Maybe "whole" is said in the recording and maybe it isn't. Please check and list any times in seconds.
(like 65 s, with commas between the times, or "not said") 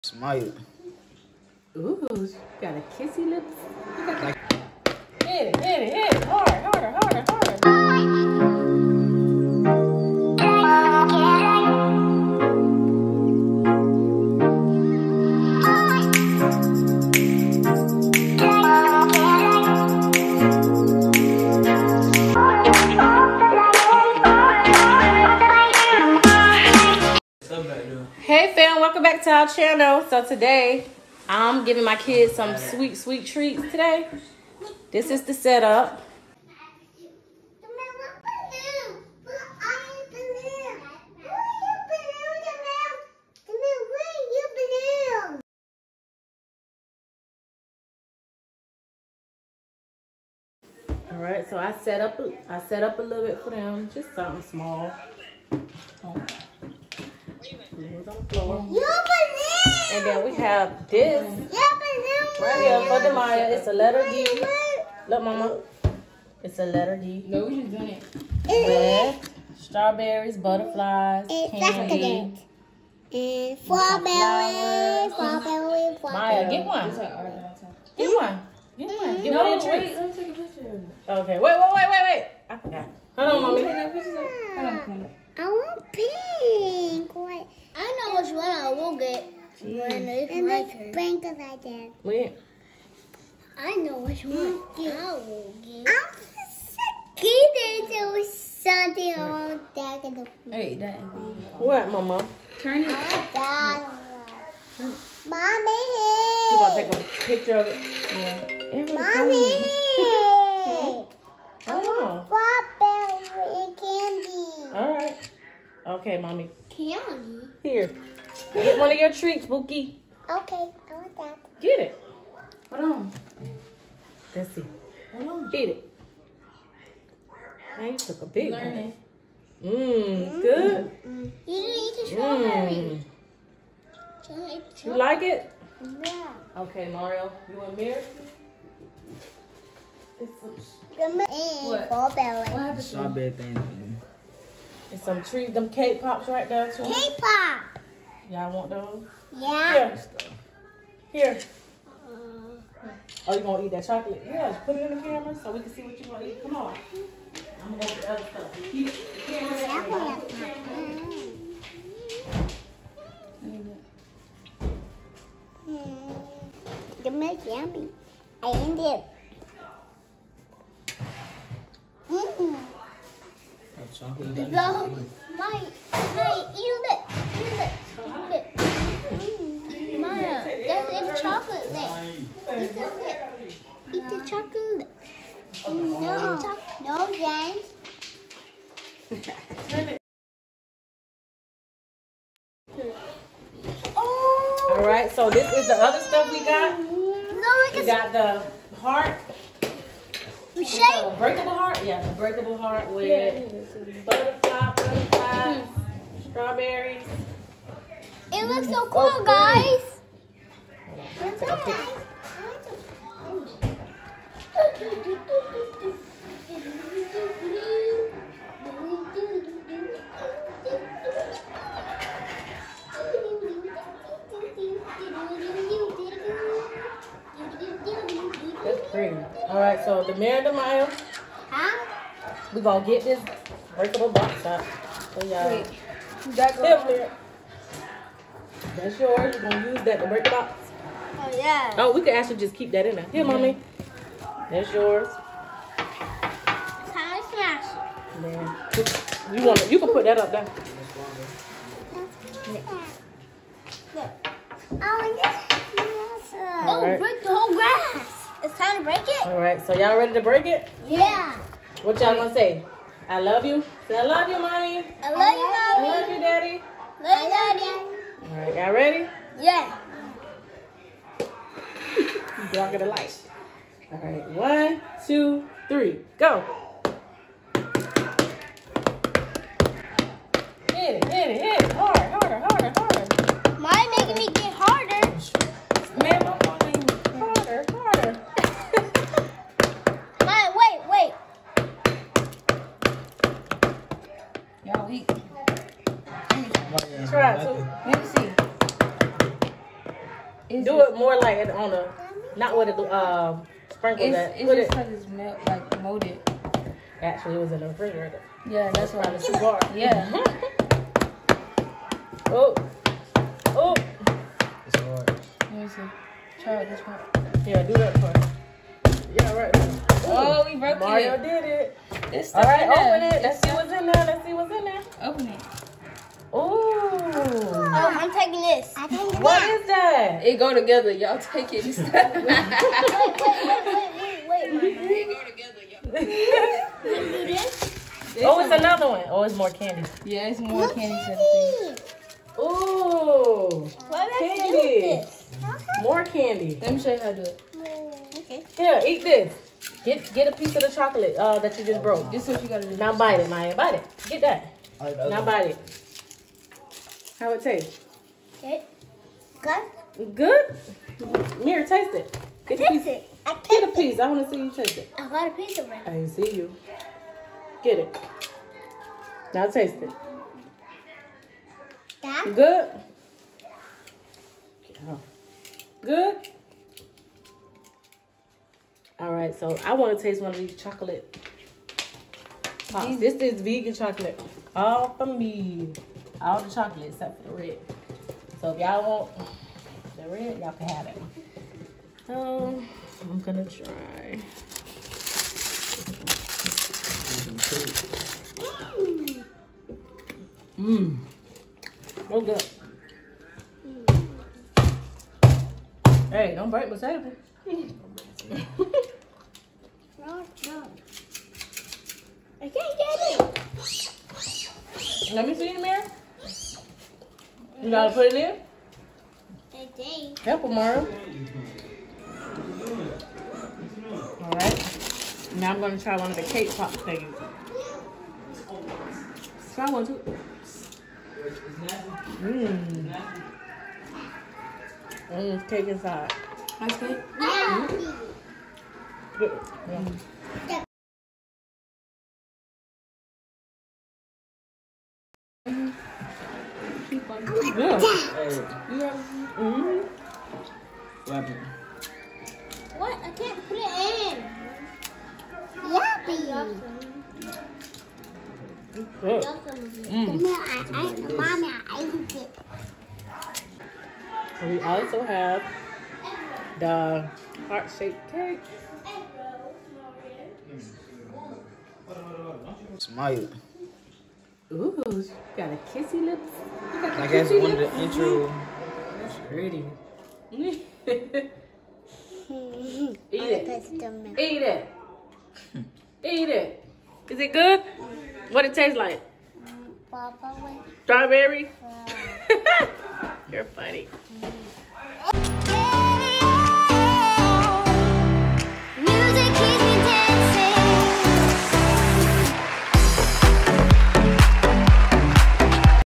257 s.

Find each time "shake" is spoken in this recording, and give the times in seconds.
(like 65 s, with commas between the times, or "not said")
200 s.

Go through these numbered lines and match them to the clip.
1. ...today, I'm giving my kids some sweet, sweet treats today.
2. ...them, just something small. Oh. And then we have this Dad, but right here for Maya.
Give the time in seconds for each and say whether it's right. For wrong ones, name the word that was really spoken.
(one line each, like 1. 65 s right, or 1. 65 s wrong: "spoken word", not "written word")
1. 30 s right
2. 53 s wrong: "Yeah", not "Dad".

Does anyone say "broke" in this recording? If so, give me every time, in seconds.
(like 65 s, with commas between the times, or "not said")
320 s, 351 s.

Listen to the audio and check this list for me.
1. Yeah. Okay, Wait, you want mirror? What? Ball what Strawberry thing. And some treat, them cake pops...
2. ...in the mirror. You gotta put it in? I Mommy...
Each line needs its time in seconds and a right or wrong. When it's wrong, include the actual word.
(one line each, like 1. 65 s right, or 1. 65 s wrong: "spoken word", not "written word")
1. 136 s wrong: "Mario", not "Wait"
2. 415 s wrong: "Help", not "Mommy".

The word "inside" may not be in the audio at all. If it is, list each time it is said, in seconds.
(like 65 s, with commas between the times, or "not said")
435 s.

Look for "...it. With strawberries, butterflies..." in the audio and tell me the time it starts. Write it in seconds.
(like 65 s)
67 s.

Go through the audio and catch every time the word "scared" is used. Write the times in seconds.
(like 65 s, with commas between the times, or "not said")
97 s.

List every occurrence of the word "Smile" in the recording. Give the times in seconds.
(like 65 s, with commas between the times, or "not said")
0 s, 472 s.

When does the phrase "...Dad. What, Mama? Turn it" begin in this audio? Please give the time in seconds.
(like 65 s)
100 s.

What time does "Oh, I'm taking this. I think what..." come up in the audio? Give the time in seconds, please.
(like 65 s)
326 s.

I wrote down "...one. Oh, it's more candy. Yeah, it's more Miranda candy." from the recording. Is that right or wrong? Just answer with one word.
wrong.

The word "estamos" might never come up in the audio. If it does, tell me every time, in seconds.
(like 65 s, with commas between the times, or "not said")
not said.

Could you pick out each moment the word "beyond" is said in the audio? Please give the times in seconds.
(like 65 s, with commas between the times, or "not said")
not said.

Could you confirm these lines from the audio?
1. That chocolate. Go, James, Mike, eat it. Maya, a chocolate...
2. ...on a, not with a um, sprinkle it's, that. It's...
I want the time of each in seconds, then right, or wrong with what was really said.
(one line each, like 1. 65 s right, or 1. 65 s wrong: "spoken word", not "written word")
1. 173 s wrong: "Mike", not "James"
2. 301 s right.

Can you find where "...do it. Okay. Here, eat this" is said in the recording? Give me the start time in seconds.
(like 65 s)
347 s.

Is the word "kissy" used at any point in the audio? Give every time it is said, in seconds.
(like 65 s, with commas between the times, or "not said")
2 s, 475 s.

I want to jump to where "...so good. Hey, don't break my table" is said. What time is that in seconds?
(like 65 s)
402 s.